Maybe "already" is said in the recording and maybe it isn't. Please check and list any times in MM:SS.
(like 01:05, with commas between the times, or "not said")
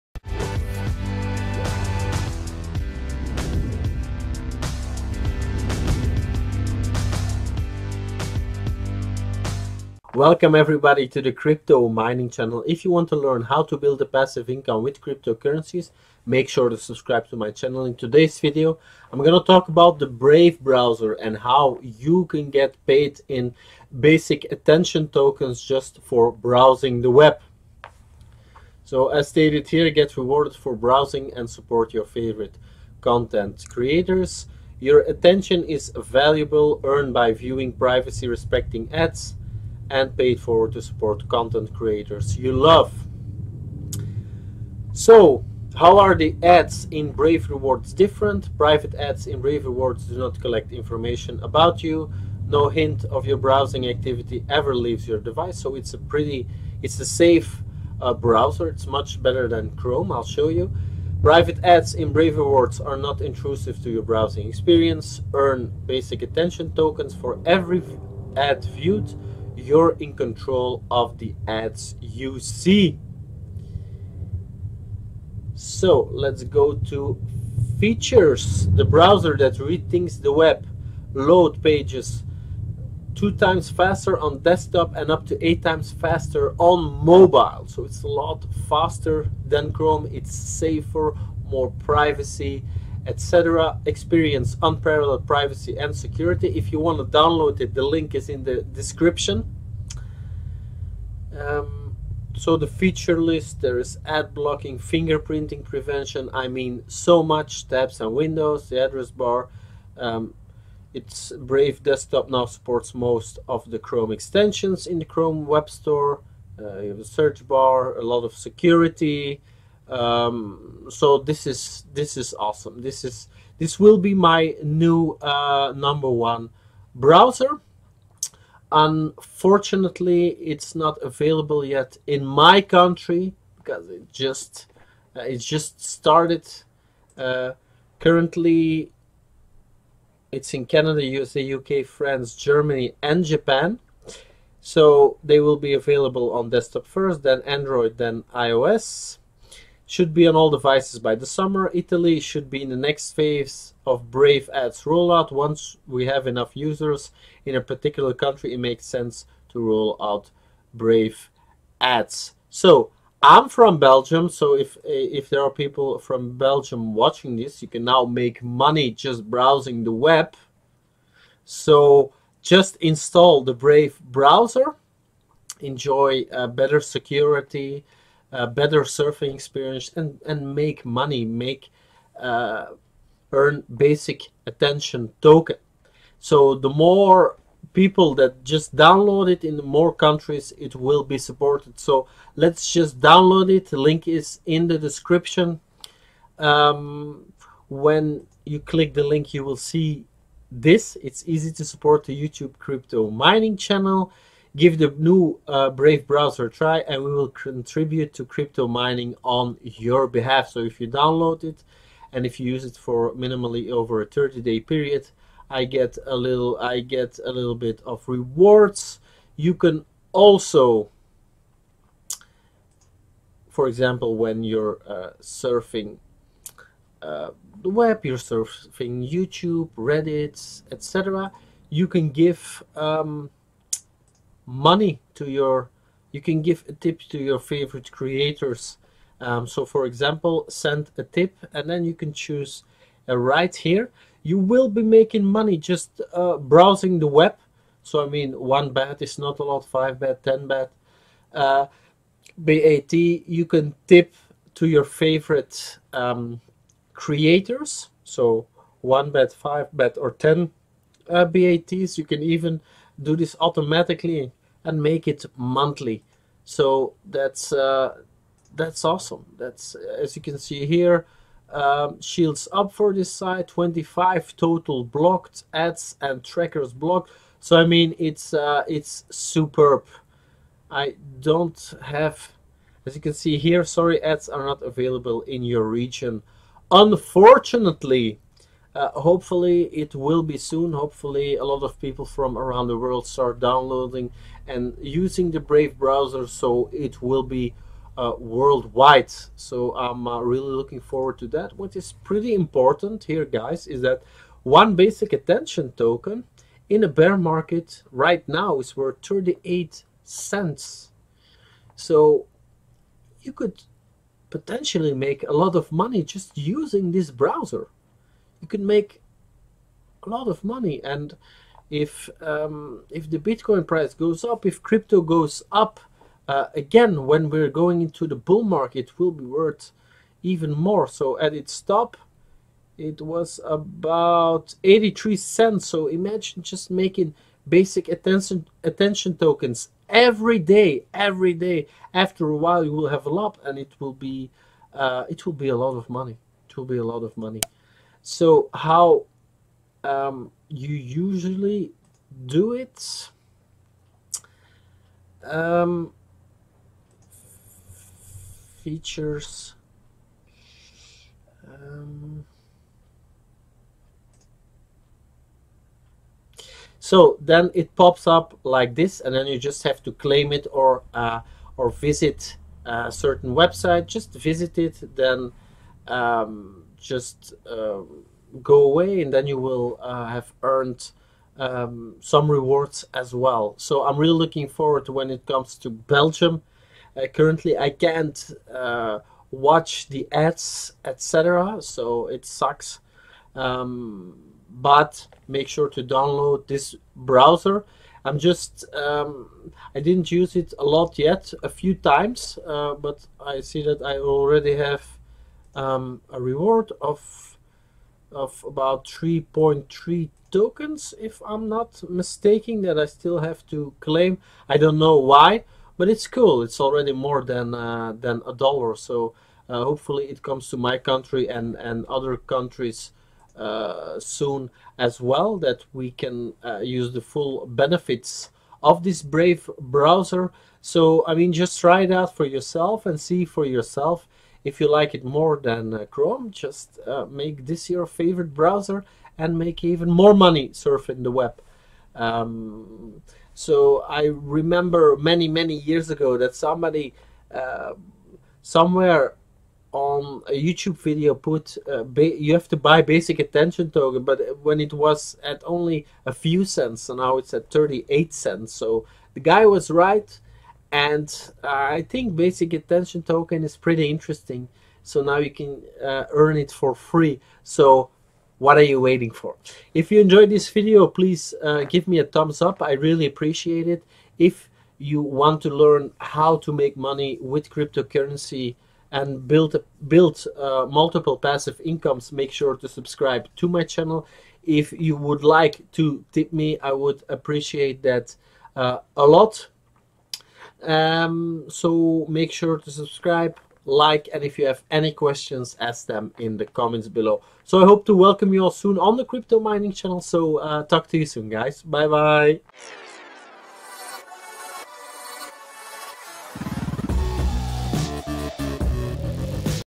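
06:43, 06:56.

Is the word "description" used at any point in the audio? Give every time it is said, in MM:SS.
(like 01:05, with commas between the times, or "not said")
01:38, 03:14.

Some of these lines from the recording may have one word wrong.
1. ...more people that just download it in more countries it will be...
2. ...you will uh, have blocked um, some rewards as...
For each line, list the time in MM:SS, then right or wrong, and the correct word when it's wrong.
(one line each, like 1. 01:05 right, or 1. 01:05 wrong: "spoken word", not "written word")
1. 03:06 right
2. 06:19 wrong: "earned", not "blocked".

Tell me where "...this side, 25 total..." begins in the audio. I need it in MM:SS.
04:32.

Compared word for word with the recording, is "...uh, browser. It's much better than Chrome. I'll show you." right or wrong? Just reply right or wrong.
right.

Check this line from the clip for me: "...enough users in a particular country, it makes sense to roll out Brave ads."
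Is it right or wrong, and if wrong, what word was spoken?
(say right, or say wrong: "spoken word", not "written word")
right.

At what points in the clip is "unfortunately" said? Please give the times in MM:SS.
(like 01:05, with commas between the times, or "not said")
02:08, 04:46.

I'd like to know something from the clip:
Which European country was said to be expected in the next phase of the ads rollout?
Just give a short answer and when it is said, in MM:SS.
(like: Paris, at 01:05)
Italy, at 02:31.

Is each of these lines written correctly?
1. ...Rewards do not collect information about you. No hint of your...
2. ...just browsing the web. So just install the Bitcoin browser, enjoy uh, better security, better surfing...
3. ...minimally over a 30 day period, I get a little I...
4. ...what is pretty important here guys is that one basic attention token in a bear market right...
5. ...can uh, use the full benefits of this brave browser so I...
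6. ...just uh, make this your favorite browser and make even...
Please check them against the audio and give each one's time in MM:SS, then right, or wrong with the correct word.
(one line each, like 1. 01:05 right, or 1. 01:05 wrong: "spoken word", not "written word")
1. 00:49 right
2. 02:48 wrong: "Brave", not "Bitcoin"
3. 03:33 right
4. 05:01 right
5. 07:05 right
6. 07:16 right.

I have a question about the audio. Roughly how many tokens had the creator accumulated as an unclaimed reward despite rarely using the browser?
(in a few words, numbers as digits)
3.3 tokens.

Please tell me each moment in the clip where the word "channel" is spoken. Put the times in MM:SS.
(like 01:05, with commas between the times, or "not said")
00:12, 00:17, 03:23, 08:03, 08:19.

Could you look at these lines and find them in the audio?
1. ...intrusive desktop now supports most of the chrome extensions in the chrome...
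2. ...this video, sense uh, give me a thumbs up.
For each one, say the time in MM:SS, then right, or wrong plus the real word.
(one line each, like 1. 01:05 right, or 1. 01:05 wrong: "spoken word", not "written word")
1. 01:51 wrong: "brave", not "intrusive"
2. 07:50 wrong: "please", not "sense".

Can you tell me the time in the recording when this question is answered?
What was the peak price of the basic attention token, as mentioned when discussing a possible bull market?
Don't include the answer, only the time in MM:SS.
05:34.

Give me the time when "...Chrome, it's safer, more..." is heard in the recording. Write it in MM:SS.
01:29.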